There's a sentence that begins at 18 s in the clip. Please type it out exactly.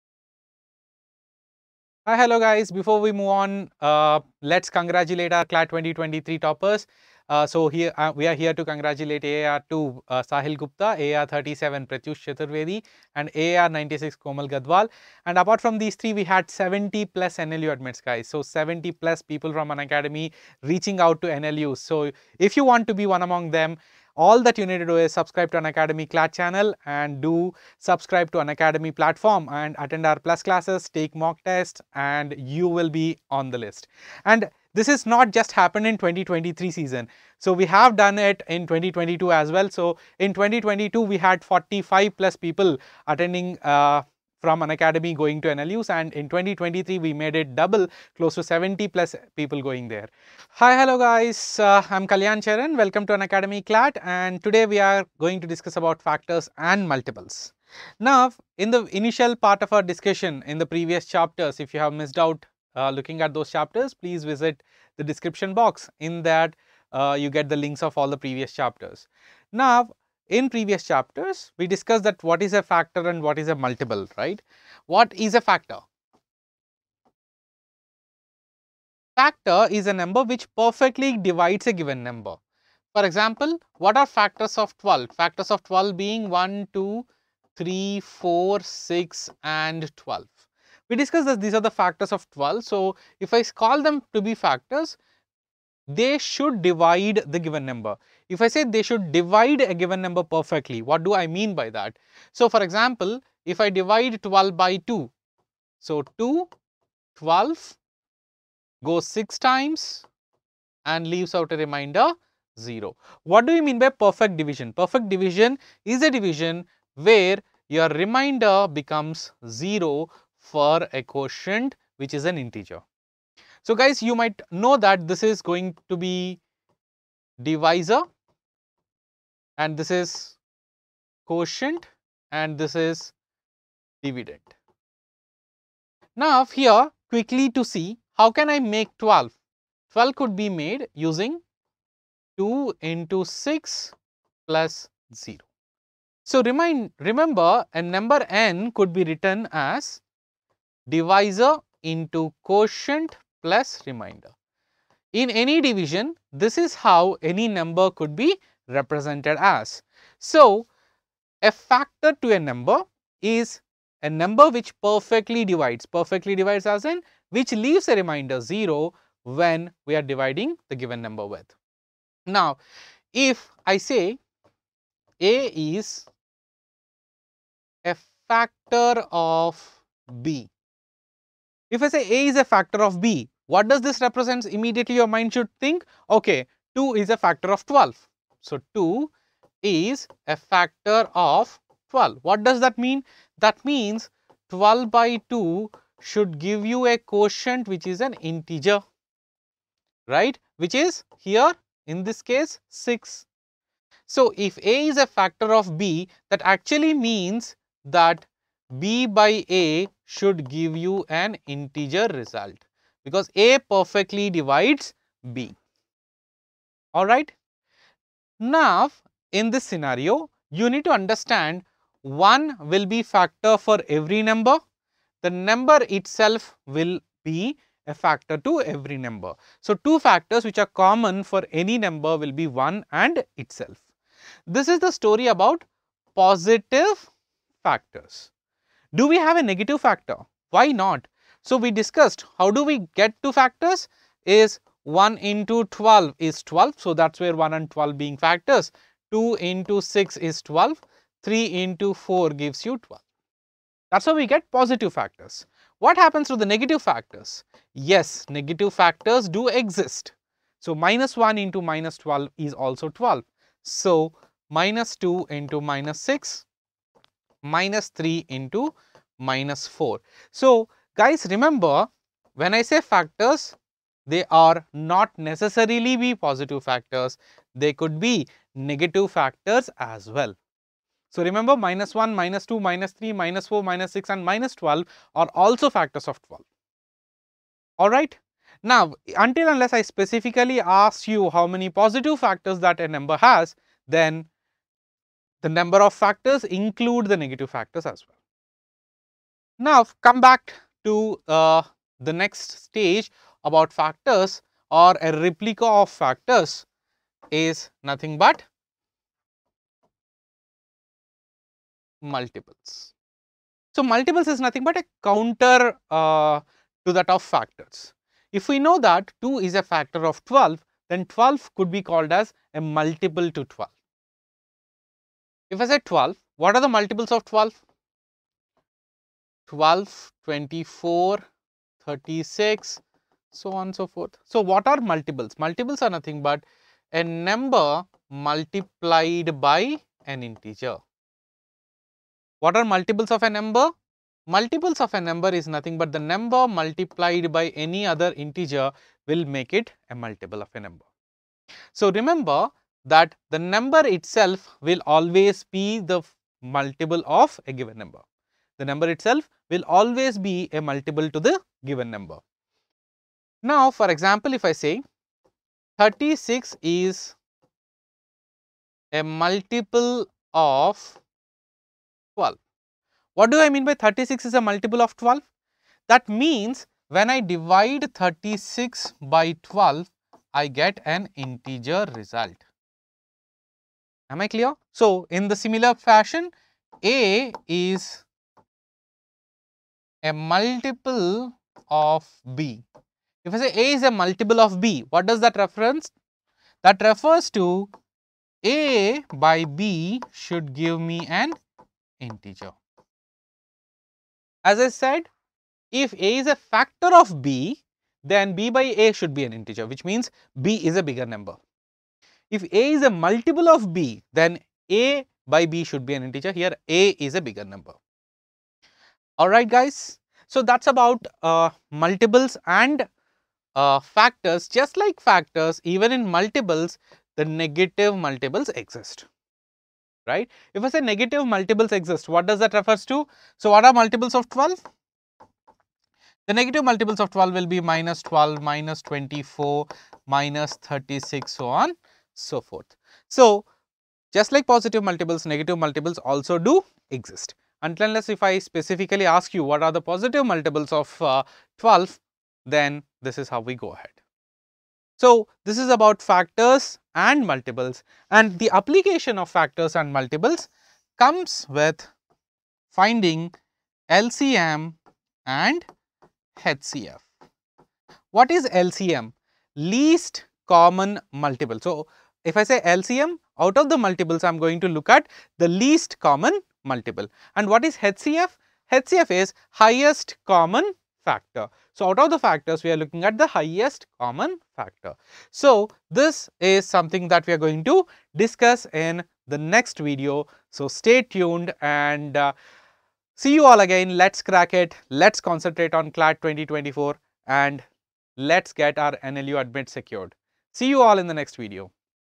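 So 70 plus people from Unacademy reaching out to NLU.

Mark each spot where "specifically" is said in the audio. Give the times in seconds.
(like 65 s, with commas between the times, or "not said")
289 s, 448 s.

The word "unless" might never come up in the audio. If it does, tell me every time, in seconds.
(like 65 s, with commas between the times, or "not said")
289 s, 447 s.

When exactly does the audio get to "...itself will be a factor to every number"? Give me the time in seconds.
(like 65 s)
225 s.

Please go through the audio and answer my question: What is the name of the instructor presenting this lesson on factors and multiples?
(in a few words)
Kalyan Charan.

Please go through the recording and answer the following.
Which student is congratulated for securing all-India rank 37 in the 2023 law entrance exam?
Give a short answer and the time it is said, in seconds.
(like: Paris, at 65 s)
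Pratyush Chaturvedi, at 11 s.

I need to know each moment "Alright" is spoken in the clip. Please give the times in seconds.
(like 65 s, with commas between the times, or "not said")
287 s, 419 s.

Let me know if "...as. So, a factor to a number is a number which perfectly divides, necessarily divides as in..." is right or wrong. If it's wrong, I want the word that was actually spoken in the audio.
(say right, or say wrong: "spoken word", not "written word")
wrong: "perfectly", not "necessarily".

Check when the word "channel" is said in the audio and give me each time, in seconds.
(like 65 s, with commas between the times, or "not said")
26 s.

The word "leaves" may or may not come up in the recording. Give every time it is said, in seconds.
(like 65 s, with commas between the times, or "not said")
111 s, 167 s.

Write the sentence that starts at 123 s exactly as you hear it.
So, guys you might know that this is going to be divisor and this is quotient and this is dividend.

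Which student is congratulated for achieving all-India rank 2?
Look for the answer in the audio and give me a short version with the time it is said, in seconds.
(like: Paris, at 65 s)
Sahil Gupta, at 10 s.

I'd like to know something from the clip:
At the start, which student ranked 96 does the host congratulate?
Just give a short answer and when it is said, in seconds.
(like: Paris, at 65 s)
Komal Gadwal, at 14 s.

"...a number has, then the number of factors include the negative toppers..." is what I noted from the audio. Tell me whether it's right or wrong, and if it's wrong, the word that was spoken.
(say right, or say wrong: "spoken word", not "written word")
wrong: "factors", not "toppers".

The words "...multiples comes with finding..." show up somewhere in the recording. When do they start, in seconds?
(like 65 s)
459 s.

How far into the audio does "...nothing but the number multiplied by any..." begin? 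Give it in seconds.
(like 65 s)
345 s.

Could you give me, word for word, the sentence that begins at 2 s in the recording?
Before we move on, uh, let's congratulate our CLAT 2023 toppers.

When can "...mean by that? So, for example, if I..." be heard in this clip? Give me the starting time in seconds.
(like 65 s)
101 s.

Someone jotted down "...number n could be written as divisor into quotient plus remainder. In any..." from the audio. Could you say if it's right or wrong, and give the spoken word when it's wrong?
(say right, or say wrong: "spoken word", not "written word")
right.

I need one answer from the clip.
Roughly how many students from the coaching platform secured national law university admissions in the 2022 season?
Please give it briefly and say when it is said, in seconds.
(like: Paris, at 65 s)
45+, at 41 s.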